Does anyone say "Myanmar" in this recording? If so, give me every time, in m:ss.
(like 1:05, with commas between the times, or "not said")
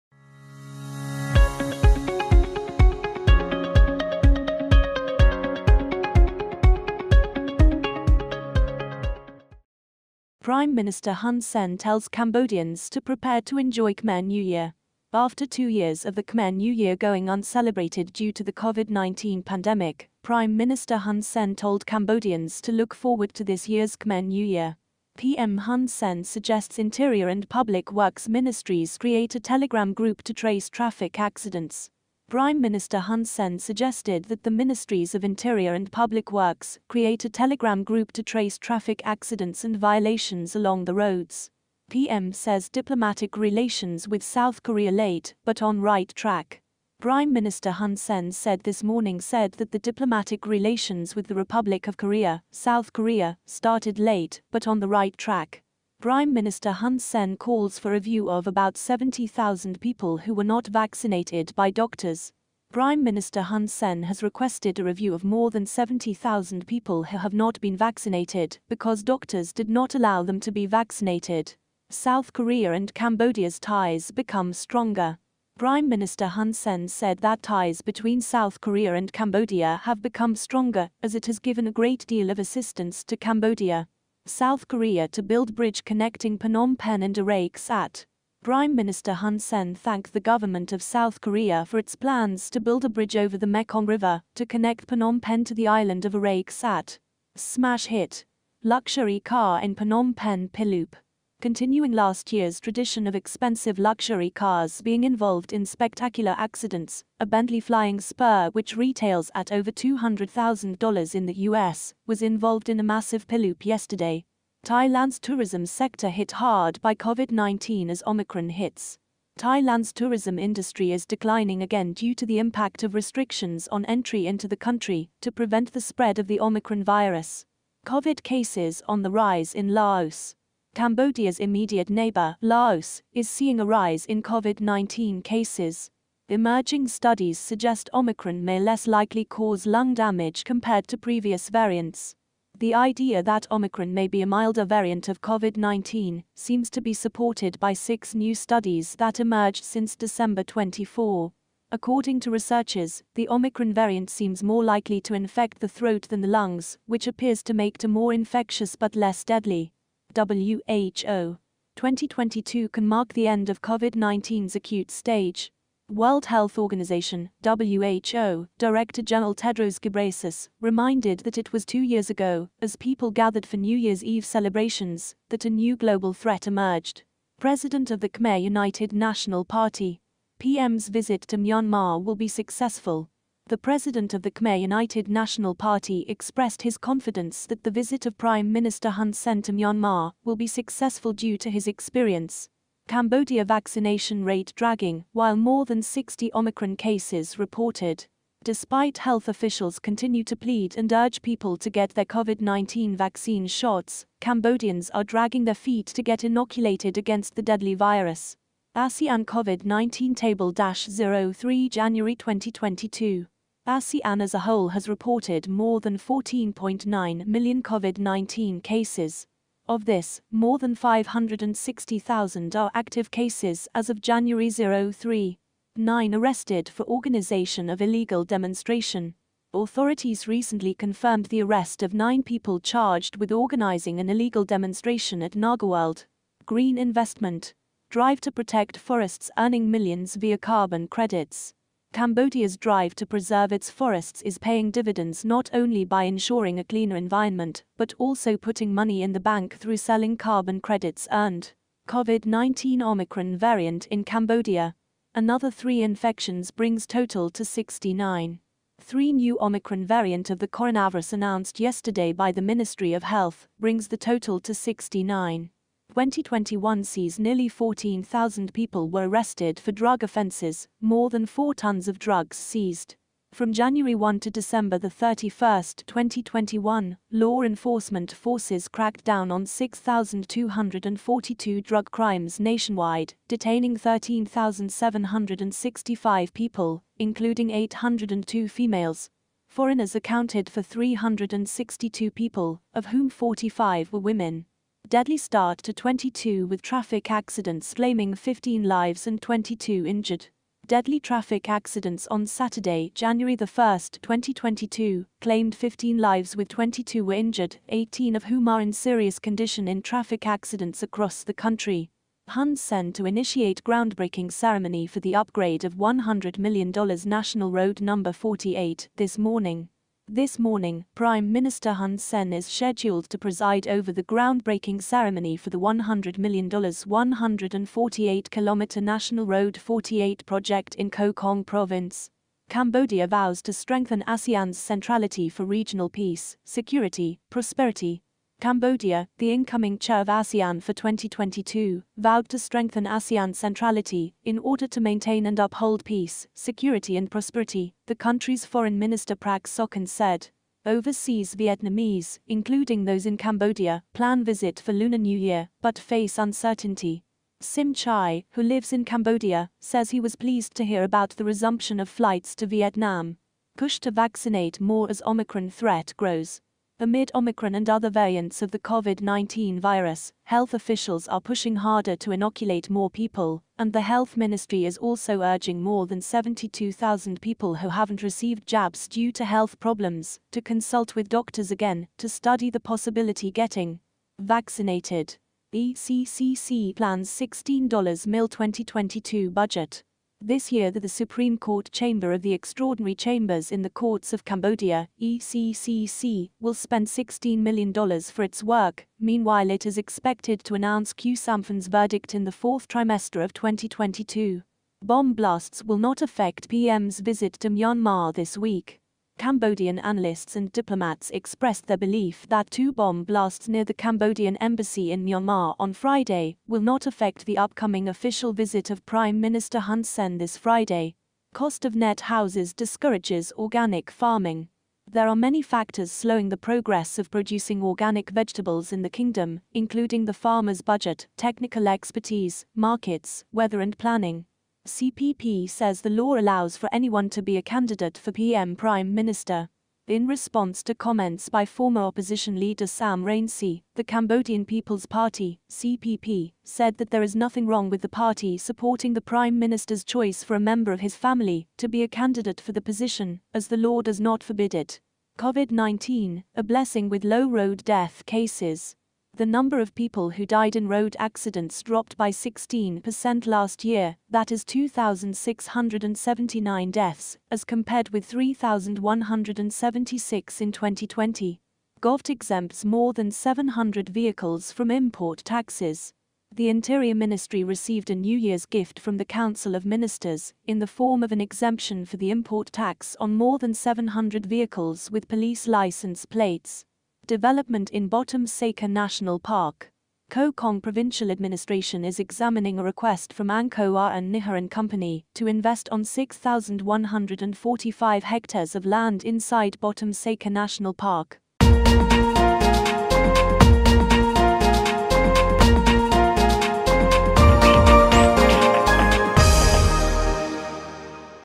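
3:01, 3:09, 6:47, 6:55.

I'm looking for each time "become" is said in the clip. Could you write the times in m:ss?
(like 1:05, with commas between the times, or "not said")
1:14, 1:20.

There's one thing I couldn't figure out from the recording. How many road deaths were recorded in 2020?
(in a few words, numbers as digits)
3,176.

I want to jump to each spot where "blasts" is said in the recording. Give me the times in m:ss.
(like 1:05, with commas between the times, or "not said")
6:45, 6:53.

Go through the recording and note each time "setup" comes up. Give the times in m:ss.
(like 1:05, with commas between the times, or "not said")
not said.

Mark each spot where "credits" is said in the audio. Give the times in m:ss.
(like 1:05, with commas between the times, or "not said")
4:00, 4:10.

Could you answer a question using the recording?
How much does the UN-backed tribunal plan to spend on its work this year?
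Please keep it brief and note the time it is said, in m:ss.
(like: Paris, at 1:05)
$16 million, at 6:36.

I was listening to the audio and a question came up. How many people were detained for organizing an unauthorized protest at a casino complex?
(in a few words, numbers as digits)
9.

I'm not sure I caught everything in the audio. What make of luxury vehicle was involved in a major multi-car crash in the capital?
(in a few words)
Bentley Flying Spur.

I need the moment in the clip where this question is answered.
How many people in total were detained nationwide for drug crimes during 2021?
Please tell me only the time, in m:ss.
4:43.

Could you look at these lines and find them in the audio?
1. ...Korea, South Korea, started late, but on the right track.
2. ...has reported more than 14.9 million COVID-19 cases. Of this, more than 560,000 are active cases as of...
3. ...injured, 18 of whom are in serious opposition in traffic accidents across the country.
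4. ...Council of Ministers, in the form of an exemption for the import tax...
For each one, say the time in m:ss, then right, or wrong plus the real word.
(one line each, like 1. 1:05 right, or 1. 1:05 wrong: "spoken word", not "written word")
1. 0:51 right
2. 3:34 right
3. 5:07 wrong: "condition", not "opposition"
4. 7:59 right.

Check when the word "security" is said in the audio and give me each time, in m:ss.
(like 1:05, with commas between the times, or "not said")
5:36, 5:46.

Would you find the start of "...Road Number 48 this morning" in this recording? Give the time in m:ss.
5:17.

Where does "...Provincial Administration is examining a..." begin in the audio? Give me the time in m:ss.
8:10.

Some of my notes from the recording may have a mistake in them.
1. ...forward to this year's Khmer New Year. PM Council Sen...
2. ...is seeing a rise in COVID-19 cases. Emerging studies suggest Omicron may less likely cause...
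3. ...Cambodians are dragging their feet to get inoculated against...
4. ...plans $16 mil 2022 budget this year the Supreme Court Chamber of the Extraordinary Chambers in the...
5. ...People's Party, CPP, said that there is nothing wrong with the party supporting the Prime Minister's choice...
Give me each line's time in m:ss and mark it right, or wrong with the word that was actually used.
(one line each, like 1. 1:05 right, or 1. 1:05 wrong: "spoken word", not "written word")
1. 0:22 wrong: "Hun", not "Council"
2. 2:13 right
3. 3:24 right
4. 6:26 right
5. 7:24 right.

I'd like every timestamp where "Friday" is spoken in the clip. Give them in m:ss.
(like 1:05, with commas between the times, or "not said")
6:55, 7:00.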